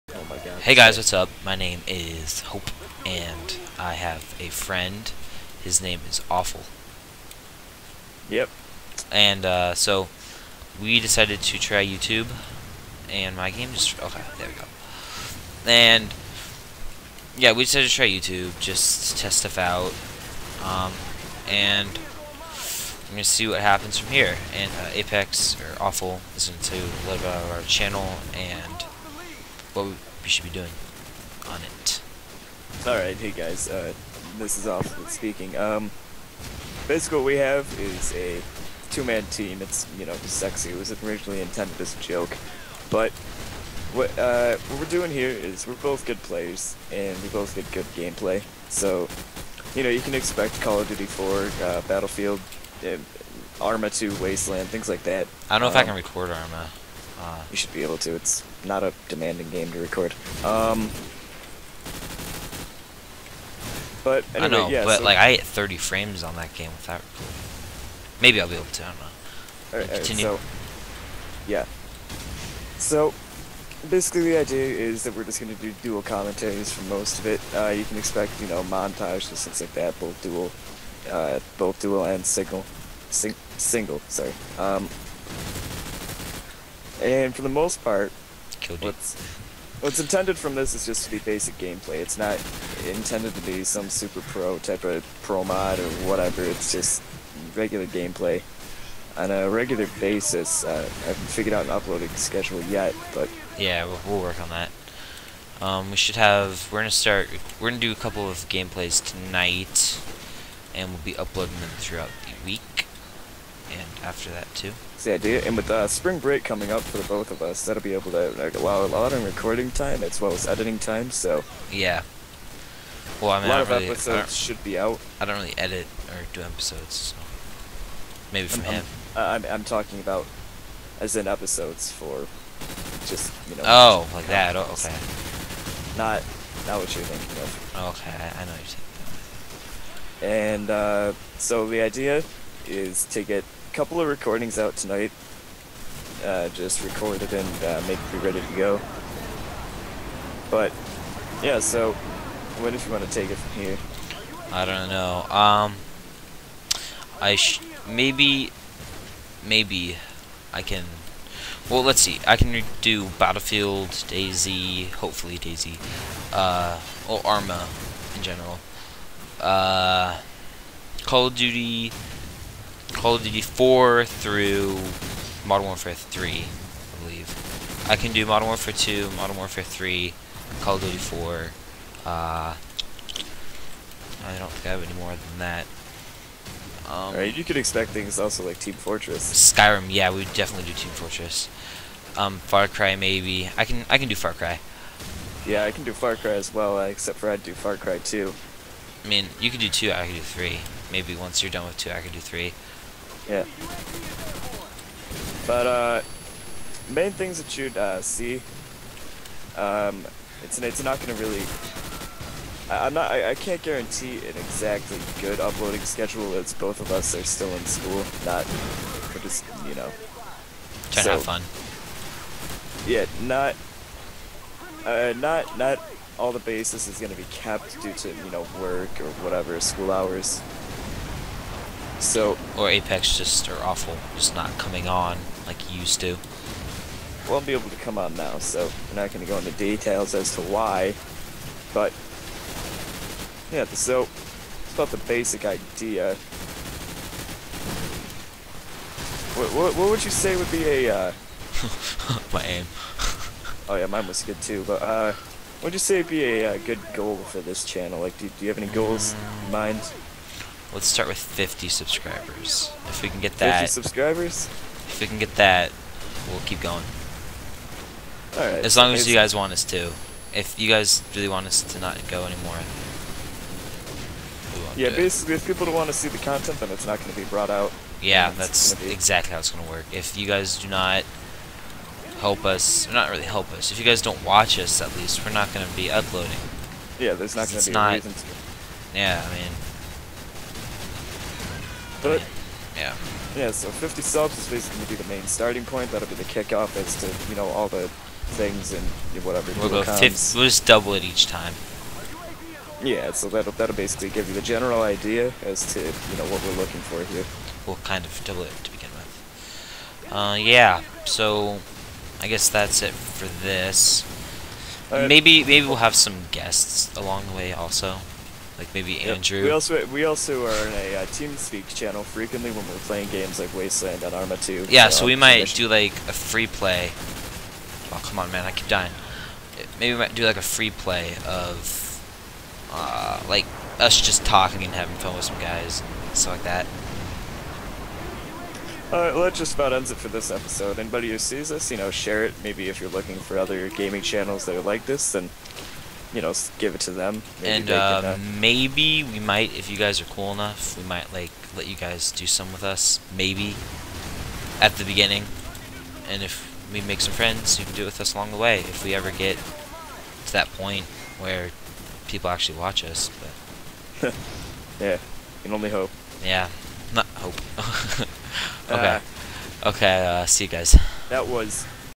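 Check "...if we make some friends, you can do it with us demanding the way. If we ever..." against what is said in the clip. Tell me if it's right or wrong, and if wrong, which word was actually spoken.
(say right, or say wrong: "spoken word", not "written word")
wrong: "along", not "demanding".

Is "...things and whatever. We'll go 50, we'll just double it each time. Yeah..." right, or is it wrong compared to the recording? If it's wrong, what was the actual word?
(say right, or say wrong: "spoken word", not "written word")
right.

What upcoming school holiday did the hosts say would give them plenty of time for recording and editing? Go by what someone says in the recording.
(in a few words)
Spring break.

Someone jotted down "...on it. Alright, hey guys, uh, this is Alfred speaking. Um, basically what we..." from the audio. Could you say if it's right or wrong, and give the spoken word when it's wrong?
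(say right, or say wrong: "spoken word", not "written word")
right.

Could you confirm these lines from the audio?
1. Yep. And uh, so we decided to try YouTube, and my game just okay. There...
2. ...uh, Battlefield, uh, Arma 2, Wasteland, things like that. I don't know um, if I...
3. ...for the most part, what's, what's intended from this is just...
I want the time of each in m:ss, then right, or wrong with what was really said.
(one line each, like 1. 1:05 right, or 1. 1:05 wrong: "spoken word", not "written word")
1. 0:08 right
2. 0:51 right
3. 1:27 right.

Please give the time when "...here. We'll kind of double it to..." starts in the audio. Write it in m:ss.
5:07.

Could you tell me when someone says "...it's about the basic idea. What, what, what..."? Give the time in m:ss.
4:04.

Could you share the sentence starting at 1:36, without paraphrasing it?
It's just regular gameplay on a regular basis.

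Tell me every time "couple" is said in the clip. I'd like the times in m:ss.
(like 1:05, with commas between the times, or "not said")
1:47, 2:23.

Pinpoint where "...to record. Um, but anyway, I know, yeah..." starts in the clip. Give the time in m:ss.
0:59.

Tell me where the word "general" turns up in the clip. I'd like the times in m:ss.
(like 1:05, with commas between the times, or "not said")
2:48, 5:04.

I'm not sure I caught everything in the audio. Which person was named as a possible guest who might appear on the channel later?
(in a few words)
Andrew.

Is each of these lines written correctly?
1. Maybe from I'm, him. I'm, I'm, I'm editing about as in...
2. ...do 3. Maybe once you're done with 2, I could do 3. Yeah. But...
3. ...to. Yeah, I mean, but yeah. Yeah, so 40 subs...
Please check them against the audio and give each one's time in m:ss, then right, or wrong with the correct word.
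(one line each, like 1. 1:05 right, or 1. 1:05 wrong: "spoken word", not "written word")
1. 2:08 wrong: "talking", not "editing"
2. 3:20 right
3. 4:48 wrong: "50", not "40".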